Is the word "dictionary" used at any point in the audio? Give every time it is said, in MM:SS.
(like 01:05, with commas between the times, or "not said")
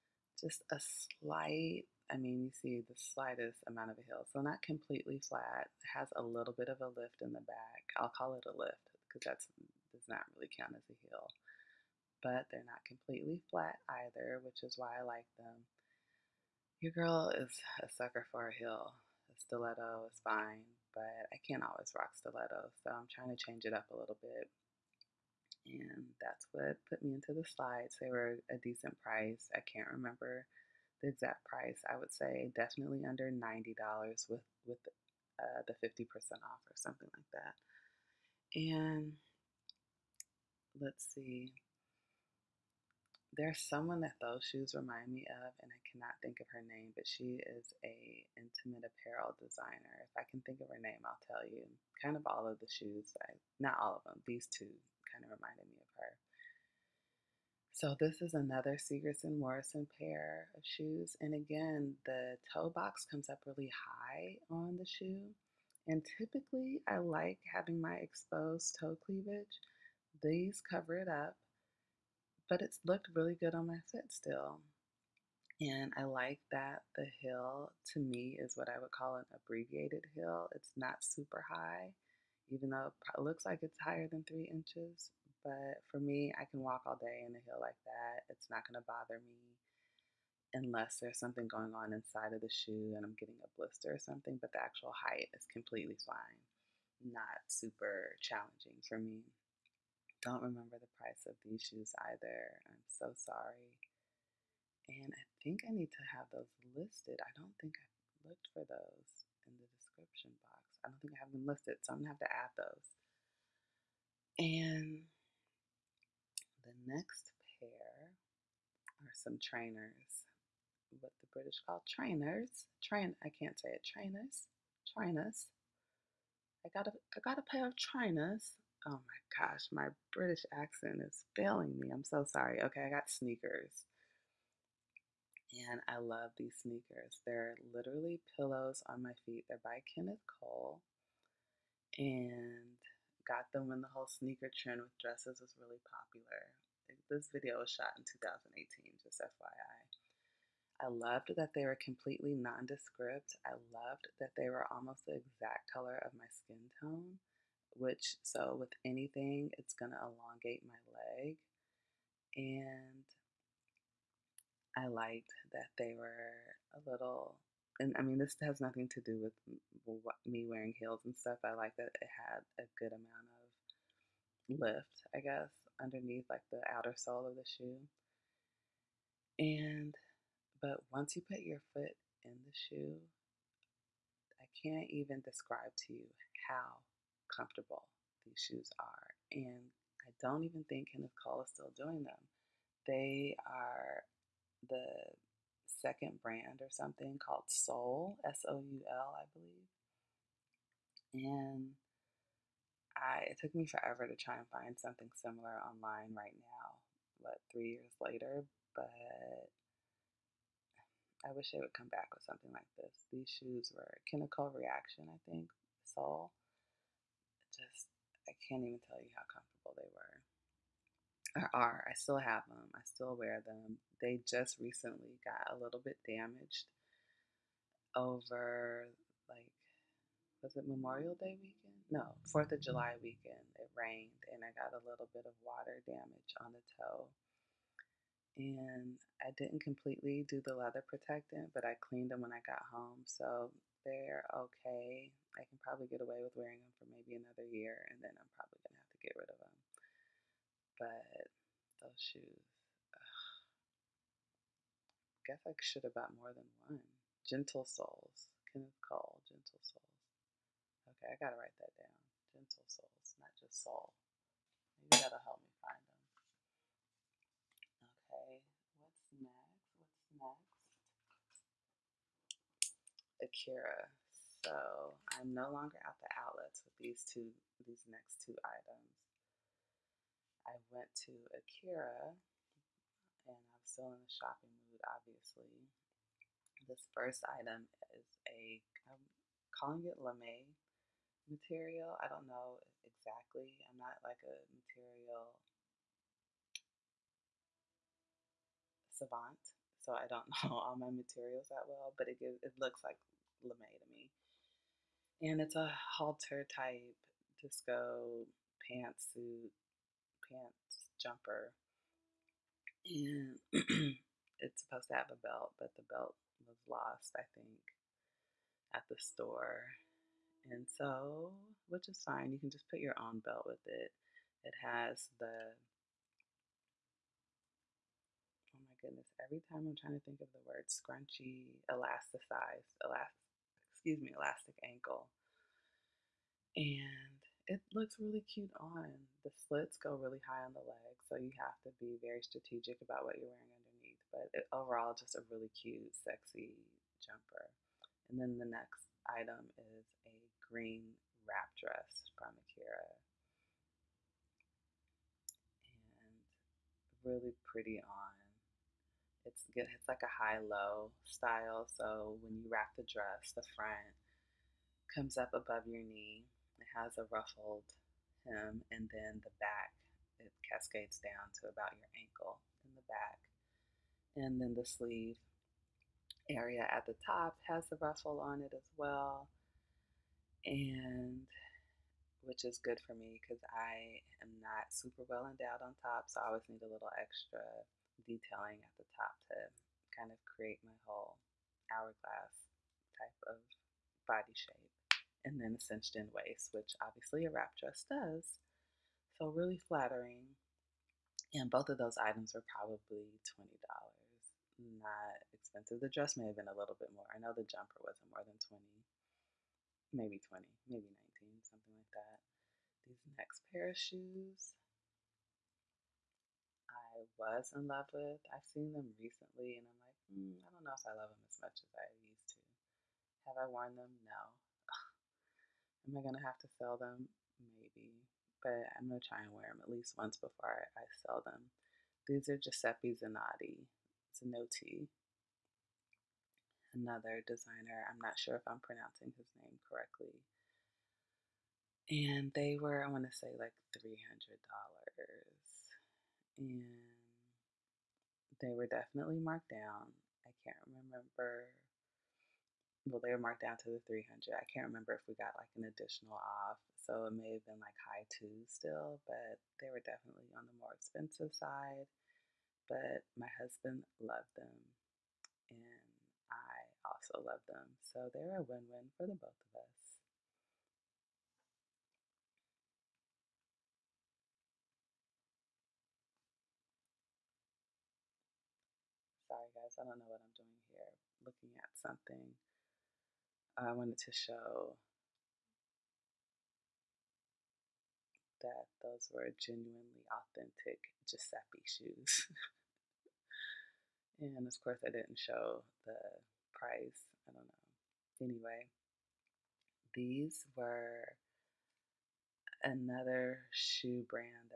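not said.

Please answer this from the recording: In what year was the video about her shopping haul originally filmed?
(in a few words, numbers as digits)
2018.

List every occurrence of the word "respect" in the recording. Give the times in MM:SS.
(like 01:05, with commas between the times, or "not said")
not said.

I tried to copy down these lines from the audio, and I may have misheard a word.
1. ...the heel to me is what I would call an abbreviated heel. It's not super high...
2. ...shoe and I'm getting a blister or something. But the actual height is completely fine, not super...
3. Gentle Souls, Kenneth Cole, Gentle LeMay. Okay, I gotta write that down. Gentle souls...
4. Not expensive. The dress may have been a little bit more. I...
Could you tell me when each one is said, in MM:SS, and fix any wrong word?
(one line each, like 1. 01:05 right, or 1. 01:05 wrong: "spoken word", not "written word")
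1. 01:16 right
2. 01:32 right
3. 04:17 wrong: "Souls", not "LeMay"
4. 06:44 right.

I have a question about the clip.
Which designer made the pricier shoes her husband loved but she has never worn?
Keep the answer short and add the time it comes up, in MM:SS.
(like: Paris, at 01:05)
Giuseppe Zanotti, at 07:12.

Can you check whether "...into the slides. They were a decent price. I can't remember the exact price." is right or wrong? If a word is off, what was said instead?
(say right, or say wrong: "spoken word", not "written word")
right.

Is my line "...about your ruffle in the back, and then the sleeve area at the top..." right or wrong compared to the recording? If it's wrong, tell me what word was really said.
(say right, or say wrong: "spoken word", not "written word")
wrong: "ankle", not "ruffle".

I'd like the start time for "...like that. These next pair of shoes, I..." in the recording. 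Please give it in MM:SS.
06:51.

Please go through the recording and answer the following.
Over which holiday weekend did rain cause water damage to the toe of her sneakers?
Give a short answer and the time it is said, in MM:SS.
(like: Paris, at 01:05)
Fourth of July, at 03:52.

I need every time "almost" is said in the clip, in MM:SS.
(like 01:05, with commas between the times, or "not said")
02:34.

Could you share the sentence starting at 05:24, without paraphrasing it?
It has the, oh my goodness, every time I'm trying to think of the word scrunchy, elasticized, elastic, excuse me, elastic ankle.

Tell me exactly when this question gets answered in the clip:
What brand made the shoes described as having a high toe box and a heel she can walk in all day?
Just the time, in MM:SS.
00:58.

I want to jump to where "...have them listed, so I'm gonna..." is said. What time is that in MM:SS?
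01:51.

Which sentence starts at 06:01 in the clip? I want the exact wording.
So when you wrap the dress, the front comes up above your knee.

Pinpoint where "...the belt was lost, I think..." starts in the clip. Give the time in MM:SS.
05:15.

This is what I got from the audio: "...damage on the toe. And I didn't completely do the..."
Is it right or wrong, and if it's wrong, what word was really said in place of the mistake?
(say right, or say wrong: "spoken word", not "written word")
right.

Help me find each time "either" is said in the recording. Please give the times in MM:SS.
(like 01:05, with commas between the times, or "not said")
00:13, 01:42.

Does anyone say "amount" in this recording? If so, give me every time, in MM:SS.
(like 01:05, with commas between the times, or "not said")
00:03, 02:52.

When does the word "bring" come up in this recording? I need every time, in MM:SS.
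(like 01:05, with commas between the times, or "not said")
not said.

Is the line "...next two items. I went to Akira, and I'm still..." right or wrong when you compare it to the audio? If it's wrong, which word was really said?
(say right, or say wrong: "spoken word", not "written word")
right.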